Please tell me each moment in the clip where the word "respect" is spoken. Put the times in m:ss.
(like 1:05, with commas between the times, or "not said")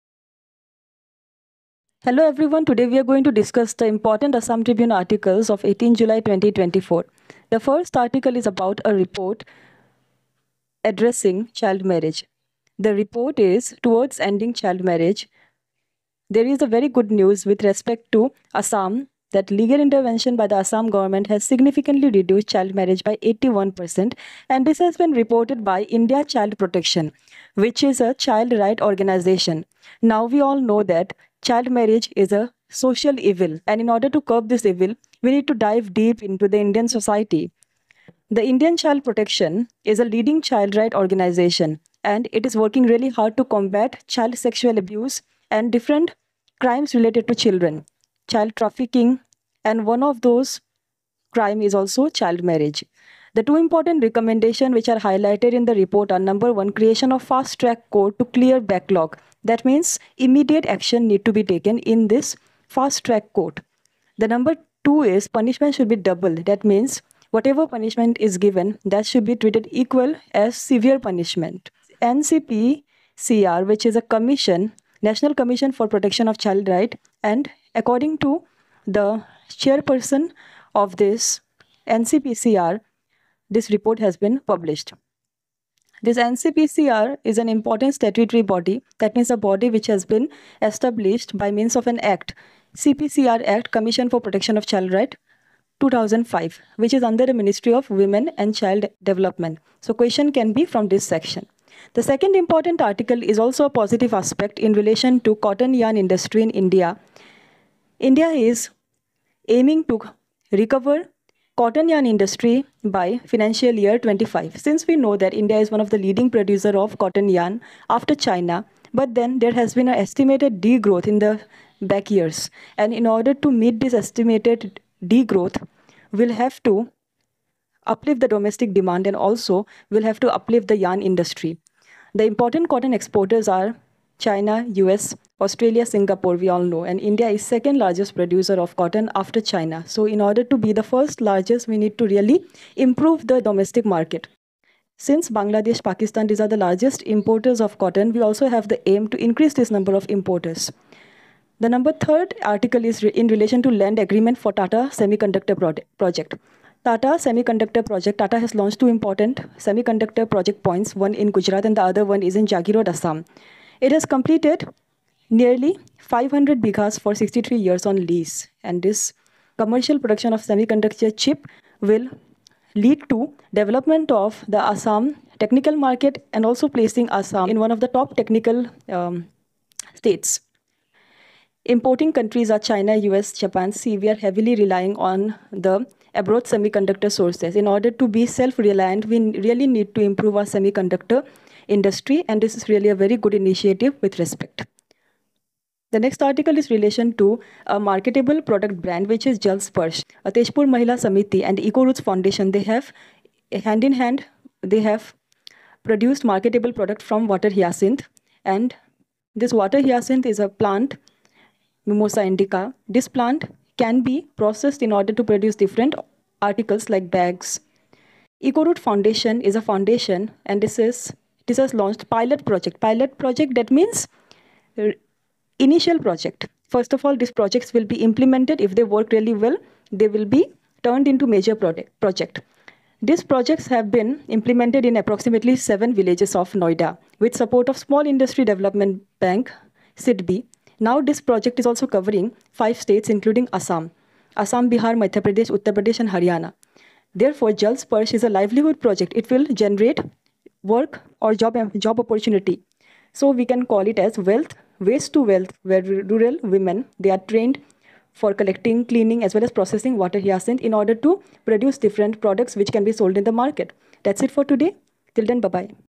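0:17, 3:14.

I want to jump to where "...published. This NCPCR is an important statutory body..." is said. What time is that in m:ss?
1:24.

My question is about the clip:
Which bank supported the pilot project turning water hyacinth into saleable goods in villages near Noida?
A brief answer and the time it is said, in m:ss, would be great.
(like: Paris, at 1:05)
Small Industry Development Bank, at 3:57.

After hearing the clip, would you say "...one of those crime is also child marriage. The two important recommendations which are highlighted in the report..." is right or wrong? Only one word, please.
right.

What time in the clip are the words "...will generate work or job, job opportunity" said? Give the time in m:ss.
4:09.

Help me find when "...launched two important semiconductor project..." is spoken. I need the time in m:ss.
2:38.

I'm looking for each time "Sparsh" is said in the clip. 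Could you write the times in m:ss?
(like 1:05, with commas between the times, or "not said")
3:19.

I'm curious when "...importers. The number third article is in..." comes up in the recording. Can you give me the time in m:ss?
2:30.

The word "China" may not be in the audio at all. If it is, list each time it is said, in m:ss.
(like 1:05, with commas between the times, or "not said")
1:58, 2:14, 2:19, 3:02.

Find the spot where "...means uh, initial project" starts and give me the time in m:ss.
3:43.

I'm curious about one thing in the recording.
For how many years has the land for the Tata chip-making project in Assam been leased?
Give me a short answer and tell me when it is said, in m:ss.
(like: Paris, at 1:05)
63 years, at 2:47.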